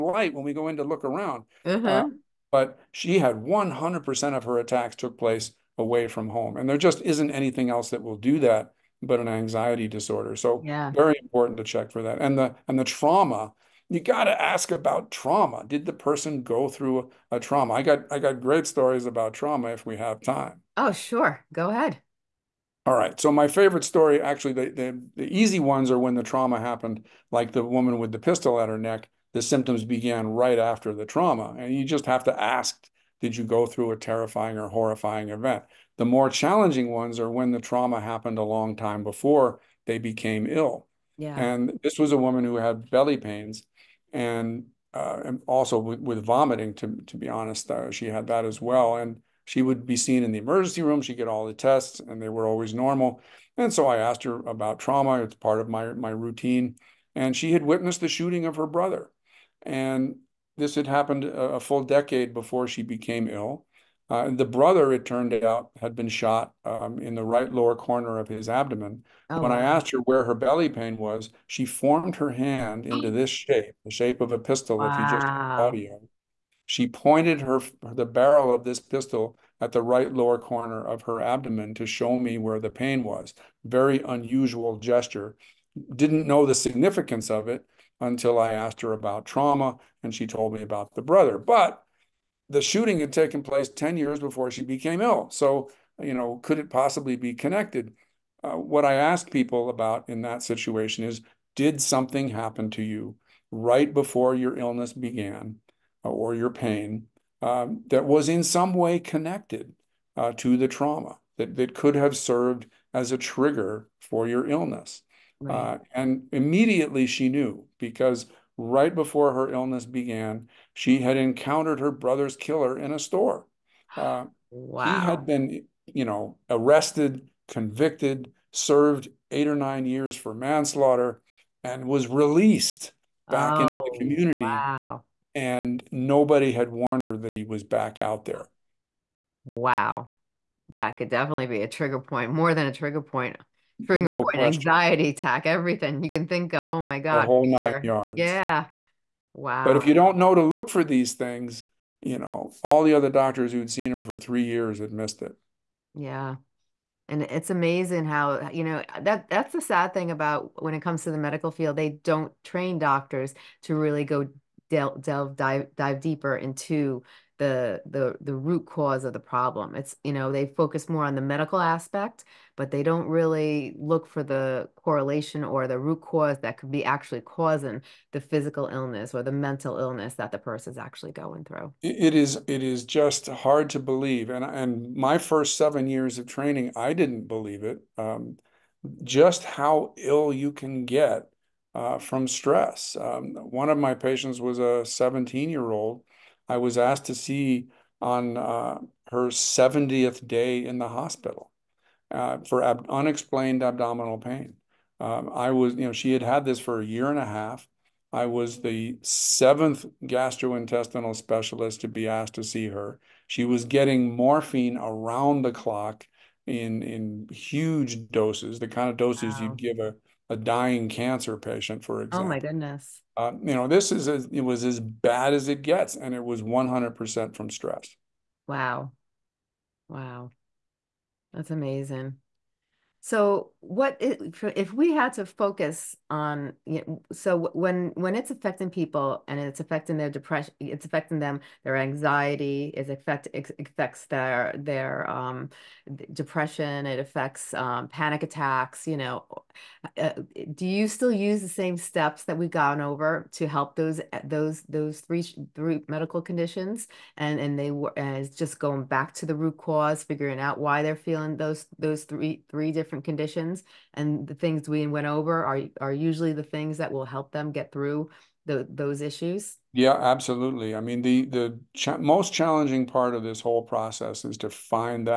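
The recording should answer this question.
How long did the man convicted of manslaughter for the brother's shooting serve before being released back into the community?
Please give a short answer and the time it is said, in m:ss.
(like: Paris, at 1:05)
8 or 9 years, at 2:09.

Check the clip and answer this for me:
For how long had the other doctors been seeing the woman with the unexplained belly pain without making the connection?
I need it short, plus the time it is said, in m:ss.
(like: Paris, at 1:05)
3 years, at 2:34.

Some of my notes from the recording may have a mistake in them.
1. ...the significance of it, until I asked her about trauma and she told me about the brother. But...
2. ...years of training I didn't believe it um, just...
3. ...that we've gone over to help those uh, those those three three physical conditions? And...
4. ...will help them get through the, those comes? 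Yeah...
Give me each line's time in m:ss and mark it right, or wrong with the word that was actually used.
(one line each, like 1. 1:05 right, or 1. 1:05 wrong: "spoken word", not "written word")
1. 1:26 right
2. 3:05 right
3. 4:12 wrong: "medical", not "physical"
4. 4:26 wrong: "issues", not "comes".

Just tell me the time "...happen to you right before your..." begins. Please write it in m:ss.
1:42.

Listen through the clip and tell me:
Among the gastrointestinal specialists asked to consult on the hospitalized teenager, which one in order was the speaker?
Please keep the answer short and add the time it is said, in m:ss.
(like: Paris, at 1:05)
seventh, at 3:29.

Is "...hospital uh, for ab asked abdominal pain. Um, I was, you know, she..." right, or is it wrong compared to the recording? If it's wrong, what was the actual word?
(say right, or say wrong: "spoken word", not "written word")
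wrong: "unexplained", not "asked".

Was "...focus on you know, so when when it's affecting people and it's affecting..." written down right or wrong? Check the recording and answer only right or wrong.
right.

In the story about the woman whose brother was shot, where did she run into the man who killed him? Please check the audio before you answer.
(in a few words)
a store.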